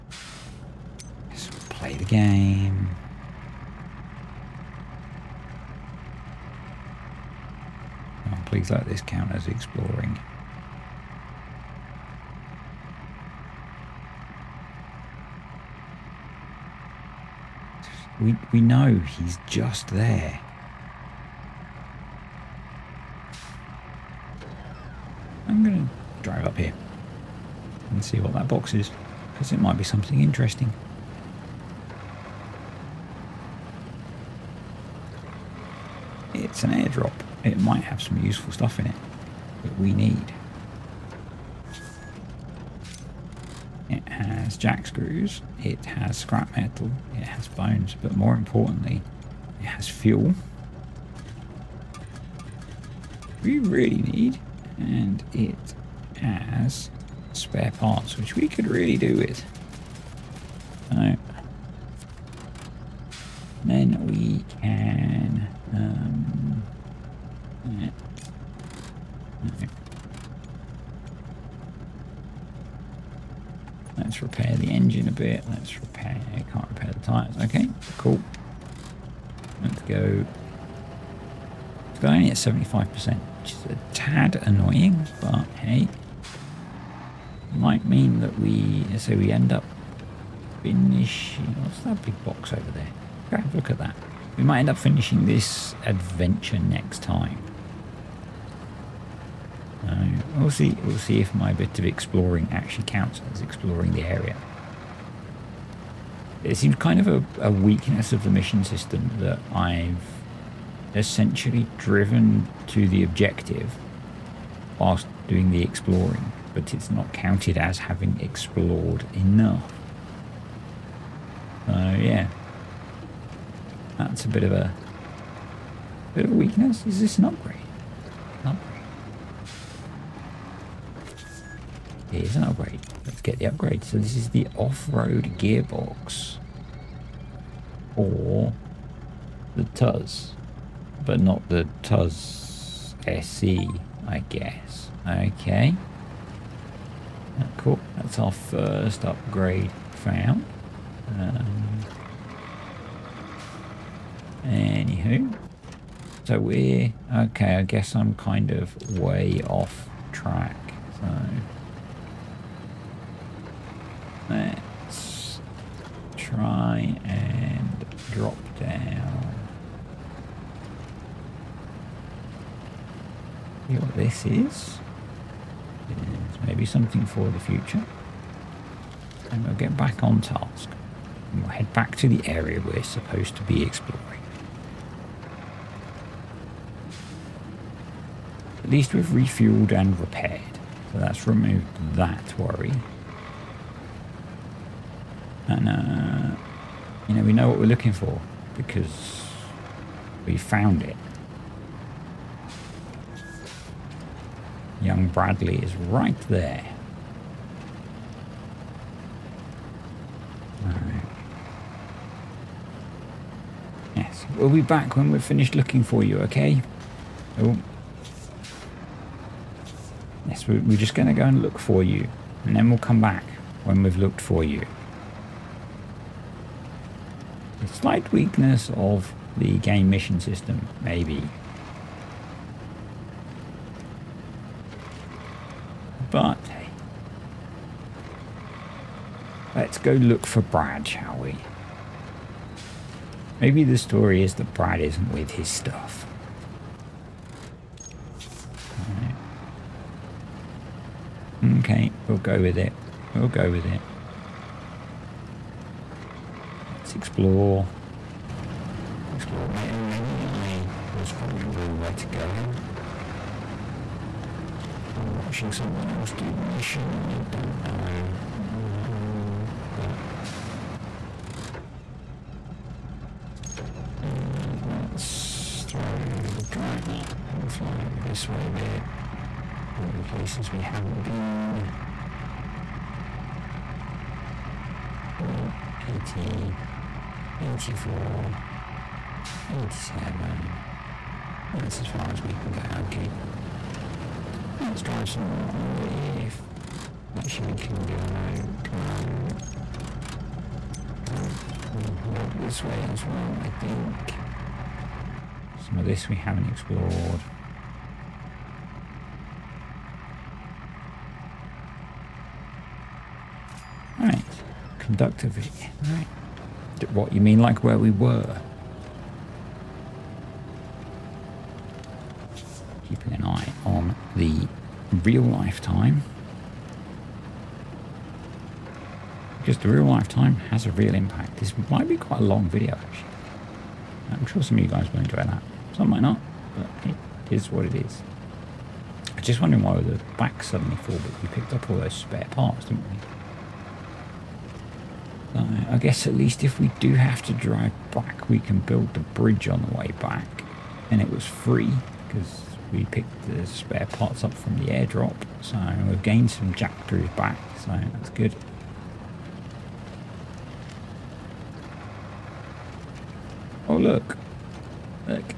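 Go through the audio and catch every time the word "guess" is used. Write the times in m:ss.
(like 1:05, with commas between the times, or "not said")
2:24, 2:37, 5:45.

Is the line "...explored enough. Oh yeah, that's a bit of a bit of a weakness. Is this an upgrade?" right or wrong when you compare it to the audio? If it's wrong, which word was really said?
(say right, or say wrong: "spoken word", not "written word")
right.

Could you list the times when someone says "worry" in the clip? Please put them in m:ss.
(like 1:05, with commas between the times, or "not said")
3:12.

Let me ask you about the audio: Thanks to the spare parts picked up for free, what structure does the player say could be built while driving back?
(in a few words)
bridge.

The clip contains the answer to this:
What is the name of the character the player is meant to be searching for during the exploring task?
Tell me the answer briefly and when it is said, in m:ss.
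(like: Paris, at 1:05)
Bradley, at 3:25.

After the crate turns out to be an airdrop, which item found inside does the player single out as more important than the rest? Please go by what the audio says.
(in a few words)
fuel.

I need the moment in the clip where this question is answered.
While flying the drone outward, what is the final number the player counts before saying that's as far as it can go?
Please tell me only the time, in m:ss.
4:49.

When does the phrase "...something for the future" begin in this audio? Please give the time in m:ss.
2:56.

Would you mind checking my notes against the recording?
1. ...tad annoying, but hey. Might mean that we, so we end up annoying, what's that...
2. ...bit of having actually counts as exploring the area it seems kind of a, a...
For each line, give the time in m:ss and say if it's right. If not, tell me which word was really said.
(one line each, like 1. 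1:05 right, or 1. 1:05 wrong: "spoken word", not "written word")
1. 1:23 wrong: "finishing", not "annoying"
2. 1:41 wrong: "exploring", not "having".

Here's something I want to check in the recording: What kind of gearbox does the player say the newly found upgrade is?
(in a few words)
off-road gearbox.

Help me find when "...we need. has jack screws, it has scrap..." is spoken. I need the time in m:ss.
0:39.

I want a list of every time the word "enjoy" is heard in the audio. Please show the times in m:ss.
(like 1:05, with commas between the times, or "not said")
5:34.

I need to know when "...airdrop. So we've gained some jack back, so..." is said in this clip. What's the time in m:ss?
5:54.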